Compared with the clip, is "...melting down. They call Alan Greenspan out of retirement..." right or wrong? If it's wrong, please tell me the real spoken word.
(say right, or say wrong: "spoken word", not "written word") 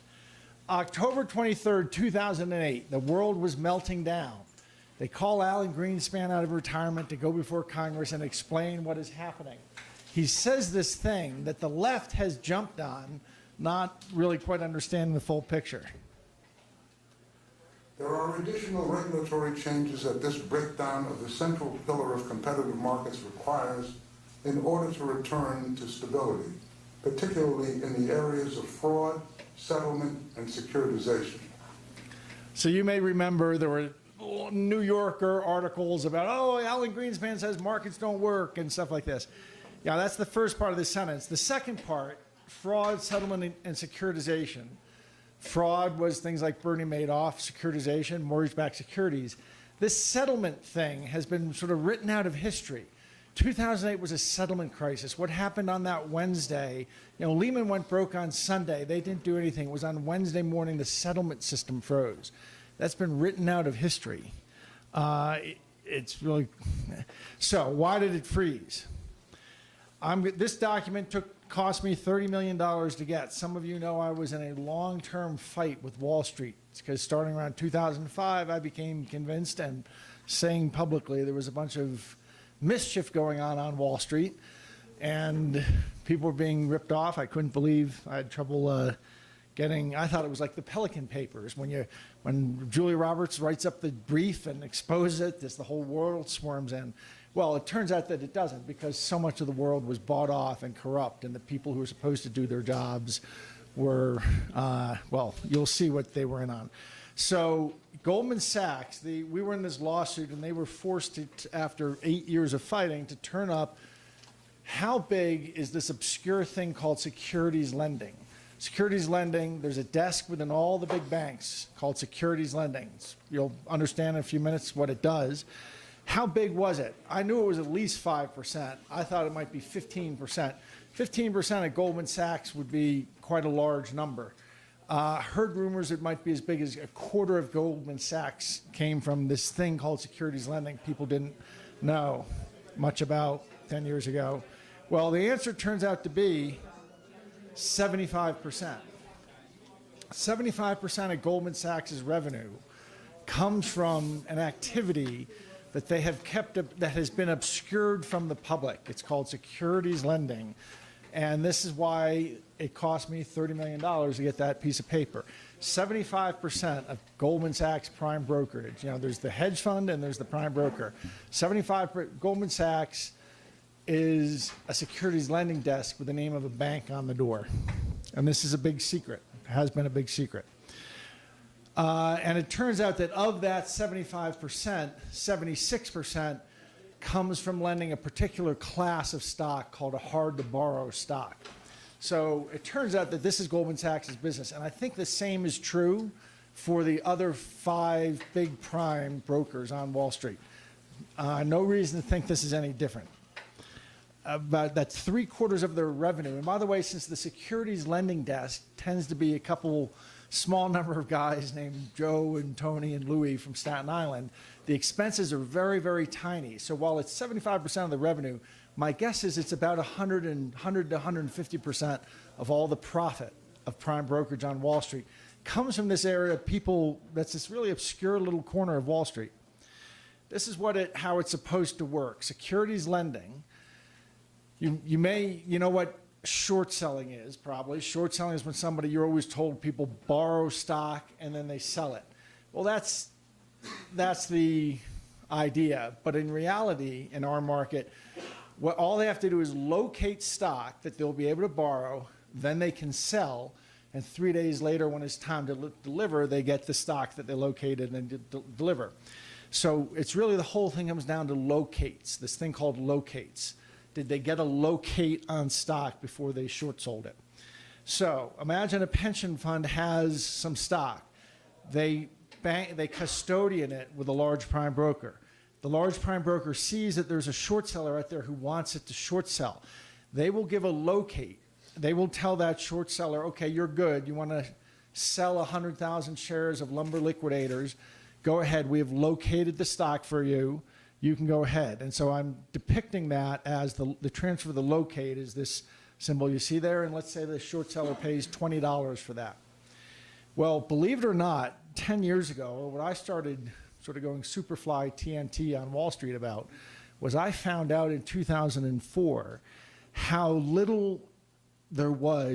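right.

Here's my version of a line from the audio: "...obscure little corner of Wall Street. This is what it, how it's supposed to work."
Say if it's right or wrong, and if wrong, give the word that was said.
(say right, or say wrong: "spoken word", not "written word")
right.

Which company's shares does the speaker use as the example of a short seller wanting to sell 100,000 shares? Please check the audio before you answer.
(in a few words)
Lumber Liquidators.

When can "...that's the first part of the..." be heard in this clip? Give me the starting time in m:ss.
0:39.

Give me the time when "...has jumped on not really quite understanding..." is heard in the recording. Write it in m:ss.
0:12.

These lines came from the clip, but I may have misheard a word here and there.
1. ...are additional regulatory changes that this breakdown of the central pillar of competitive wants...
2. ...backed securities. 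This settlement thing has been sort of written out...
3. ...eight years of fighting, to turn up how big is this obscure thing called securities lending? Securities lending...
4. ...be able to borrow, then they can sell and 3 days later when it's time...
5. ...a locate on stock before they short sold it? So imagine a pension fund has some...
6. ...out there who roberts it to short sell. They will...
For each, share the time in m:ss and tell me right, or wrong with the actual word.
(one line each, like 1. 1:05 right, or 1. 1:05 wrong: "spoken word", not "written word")
1. 0:18 wrong: "markets", not "wants"
2. 0:48 right
3. 1:52 right
4. 4:11 right
5. 4:24 right
6. 4:37 wrong: "wants", not "roberts".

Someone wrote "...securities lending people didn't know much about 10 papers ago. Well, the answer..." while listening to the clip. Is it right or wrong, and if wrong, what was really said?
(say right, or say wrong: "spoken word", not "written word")
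wrong: "years", not "papers".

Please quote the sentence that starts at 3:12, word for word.
So it turns out that this is Goldman Sachs' business.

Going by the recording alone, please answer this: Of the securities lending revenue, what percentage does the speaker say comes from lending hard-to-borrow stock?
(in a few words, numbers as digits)
76%.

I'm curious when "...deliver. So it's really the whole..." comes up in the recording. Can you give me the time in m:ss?
4:18.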